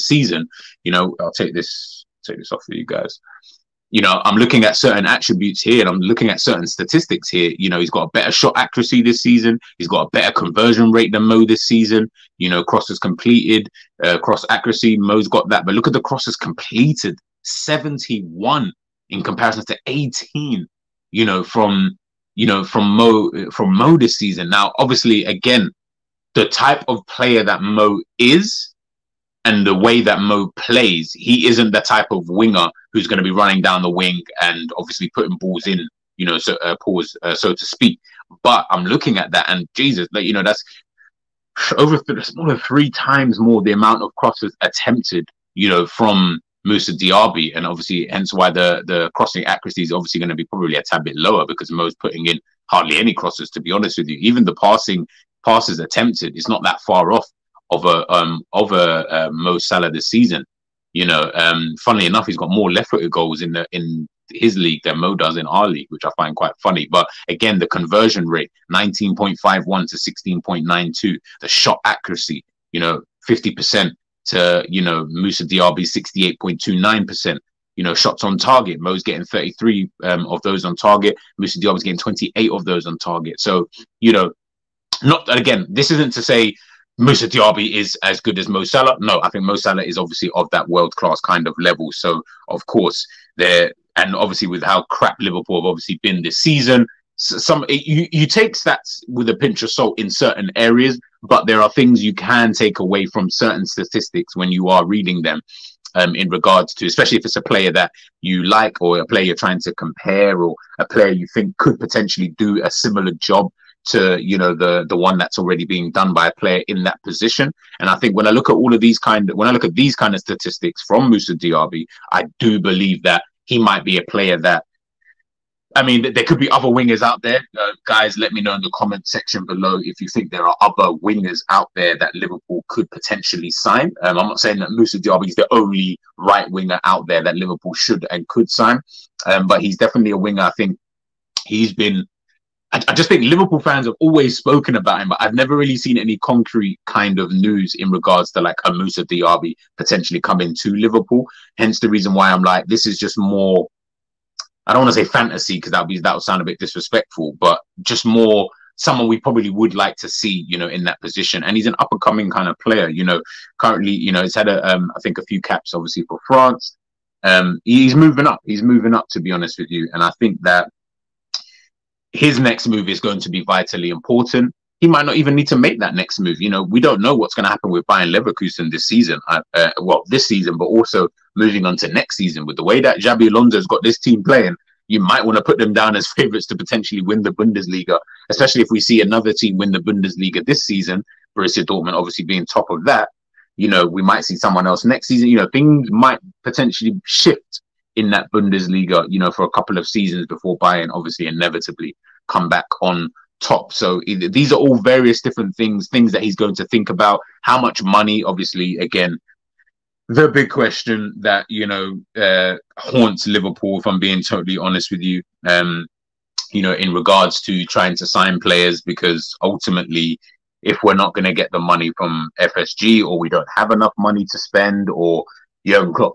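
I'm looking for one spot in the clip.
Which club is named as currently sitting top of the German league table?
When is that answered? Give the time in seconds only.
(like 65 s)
191 s.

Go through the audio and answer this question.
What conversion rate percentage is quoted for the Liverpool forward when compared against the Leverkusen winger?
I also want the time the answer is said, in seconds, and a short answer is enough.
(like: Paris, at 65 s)
19.51, at 68 s.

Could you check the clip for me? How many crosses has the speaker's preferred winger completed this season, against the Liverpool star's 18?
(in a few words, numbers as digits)
71.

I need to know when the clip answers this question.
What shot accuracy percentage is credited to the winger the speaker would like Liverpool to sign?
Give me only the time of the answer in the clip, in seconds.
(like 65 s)
76 s.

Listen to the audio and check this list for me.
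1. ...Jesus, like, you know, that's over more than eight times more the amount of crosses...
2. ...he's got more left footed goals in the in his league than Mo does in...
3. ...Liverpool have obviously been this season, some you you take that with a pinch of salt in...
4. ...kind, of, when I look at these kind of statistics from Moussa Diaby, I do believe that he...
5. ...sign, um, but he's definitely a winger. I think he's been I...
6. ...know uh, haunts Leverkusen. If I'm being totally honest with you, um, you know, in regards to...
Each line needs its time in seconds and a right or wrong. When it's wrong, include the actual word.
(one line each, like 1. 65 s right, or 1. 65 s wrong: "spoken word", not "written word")
1. 39 s wrong: "three", not "eight"
2. 62 s right
3. 95 s right
4. 118 s right
5. 138 s right
6. 211 s wrong: "Liverpool", not "Leverkusen".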